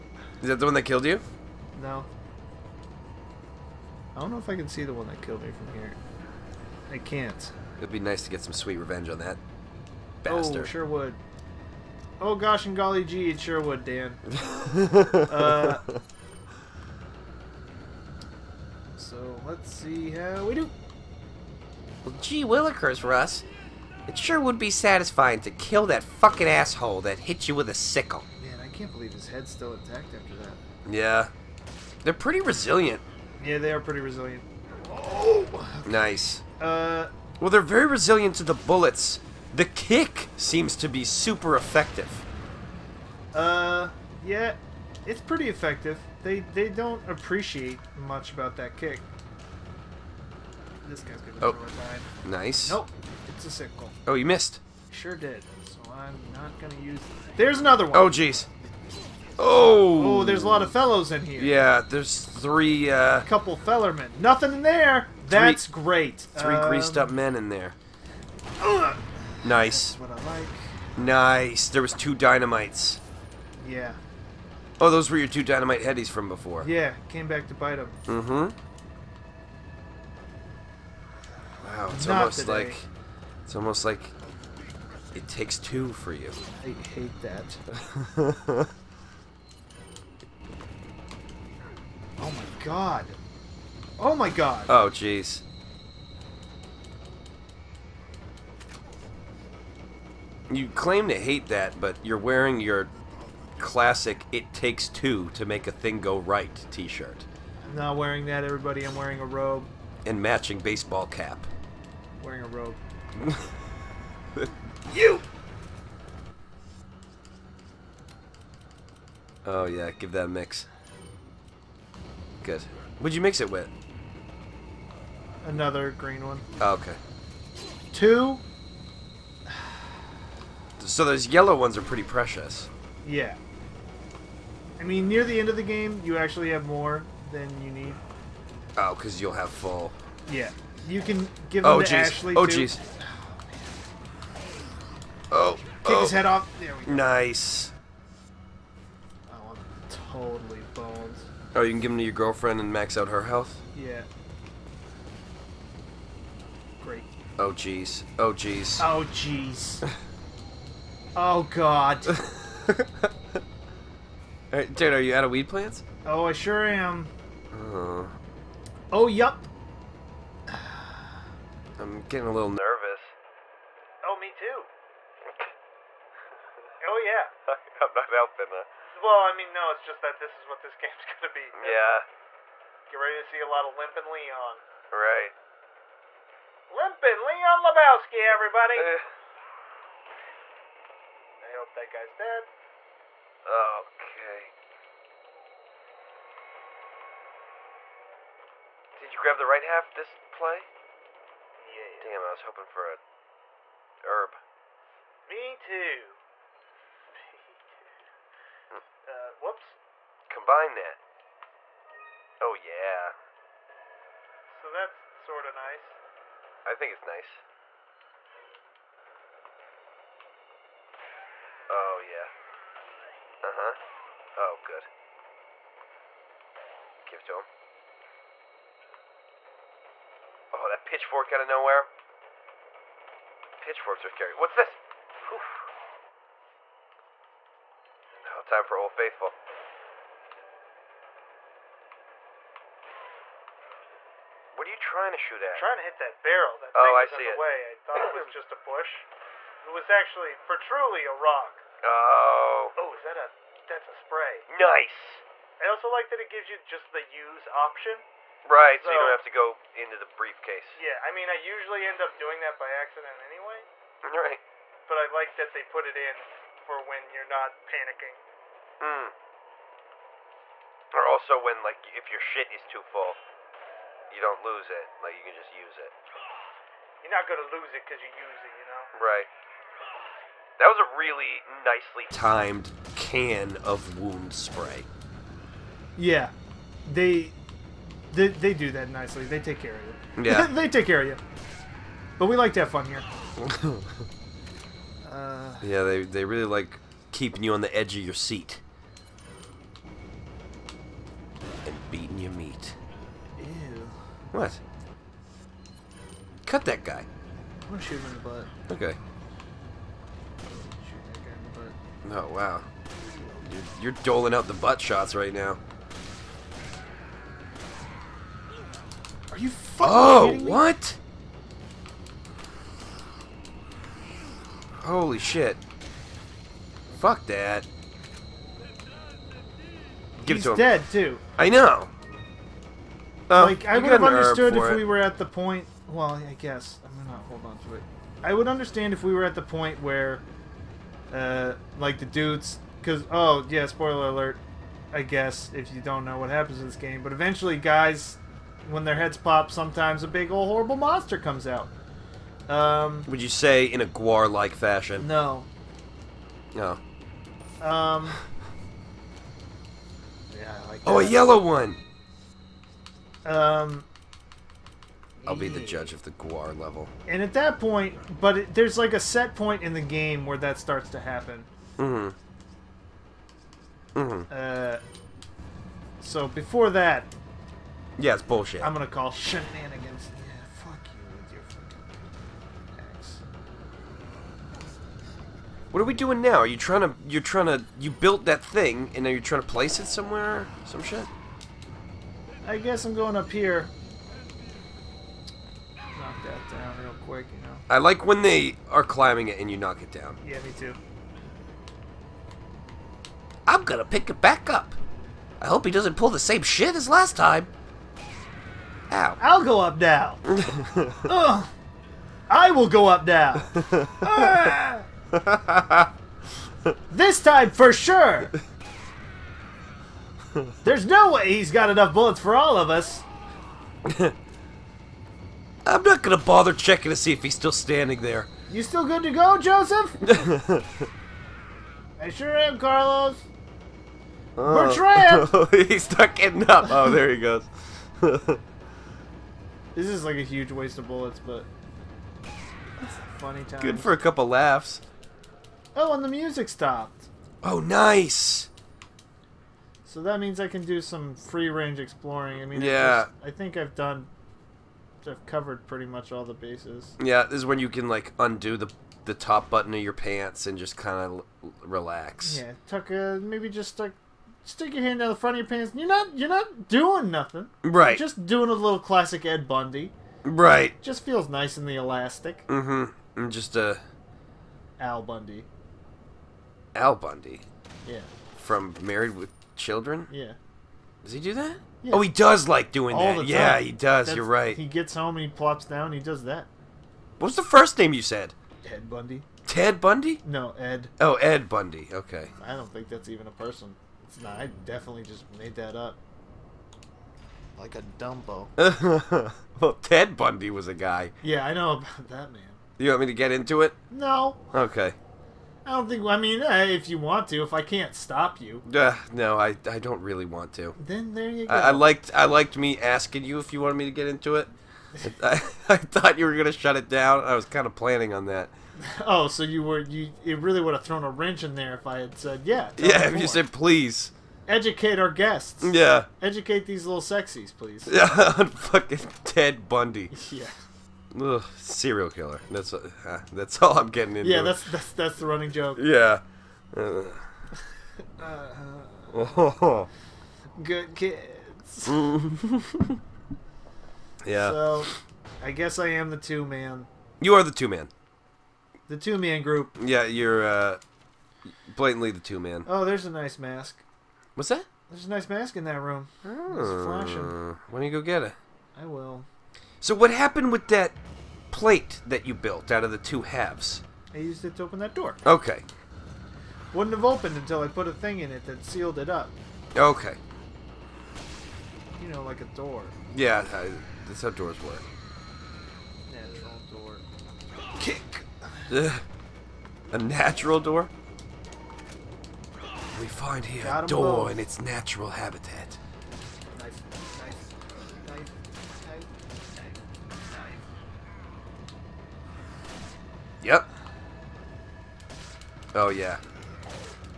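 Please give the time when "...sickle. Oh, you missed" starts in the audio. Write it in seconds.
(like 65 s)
53 s.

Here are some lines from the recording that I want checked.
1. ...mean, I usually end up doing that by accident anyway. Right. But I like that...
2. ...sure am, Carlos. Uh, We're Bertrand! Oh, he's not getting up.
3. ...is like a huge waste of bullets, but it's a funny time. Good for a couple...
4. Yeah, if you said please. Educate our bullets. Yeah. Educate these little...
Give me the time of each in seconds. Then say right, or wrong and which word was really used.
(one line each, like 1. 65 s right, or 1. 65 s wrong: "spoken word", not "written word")
1. 261 s right
2. 432 s right
3. 439 s right
4. 522 s wrong: "guests", not "bullets".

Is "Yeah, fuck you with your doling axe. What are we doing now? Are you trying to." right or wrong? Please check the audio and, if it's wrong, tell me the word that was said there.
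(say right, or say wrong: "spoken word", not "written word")
wrong: "fucking", not "doling".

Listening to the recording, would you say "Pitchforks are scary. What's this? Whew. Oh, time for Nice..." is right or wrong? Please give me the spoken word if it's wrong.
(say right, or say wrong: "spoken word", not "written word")
wrong: "Old", not "Nice".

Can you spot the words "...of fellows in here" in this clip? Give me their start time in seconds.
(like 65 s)
60 s.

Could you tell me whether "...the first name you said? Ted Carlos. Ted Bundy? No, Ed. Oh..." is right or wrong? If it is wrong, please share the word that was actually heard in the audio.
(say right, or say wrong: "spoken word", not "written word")
wrong: "Bundy", not "Carlos".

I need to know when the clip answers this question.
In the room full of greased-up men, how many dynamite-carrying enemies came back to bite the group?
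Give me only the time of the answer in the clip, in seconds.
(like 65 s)
71 s.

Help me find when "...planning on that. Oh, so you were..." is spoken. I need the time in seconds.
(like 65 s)
517 s.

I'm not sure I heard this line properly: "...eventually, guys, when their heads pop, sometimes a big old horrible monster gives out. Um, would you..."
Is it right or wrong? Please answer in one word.
wrong.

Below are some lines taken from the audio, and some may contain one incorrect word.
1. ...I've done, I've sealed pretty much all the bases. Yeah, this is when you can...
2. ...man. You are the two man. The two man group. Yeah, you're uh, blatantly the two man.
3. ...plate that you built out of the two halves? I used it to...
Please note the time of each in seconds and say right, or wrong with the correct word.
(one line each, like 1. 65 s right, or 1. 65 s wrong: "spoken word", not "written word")
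1. 453 s wrong: "covered", not "sealed"
2. 546 s right
3. 561 s right.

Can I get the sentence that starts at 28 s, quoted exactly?
Man, I can't believe his head's still intact after that.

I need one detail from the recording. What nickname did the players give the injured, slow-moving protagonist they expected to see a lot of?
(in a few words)
Limping Leon Lebowski.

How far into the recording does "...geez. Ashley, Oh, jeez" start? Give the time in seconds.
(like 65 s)
141 s.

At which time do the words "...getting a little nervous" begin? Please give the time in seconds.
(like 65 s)
172 s.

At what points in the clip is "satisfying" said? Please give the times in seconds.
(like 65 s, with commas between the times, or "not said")
24 s.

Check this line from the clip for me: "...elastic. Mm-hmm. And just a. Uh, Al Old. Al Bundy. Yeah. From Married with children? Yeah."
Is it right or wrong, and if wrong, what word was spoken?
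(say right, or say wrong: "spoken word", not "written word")
wrong: "Bundy", not "Old".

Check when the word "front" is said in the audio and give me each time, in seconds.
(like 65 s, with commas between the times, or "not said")
465 s.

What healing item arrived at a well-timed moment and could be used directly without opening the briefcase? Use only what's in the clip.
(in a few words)
Wound spray.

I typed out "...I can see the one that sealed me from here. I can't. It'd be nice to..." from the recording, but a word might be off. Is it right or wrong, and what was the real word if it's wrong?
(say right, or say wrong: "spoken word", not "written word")
wrong: "killed", not "sealed".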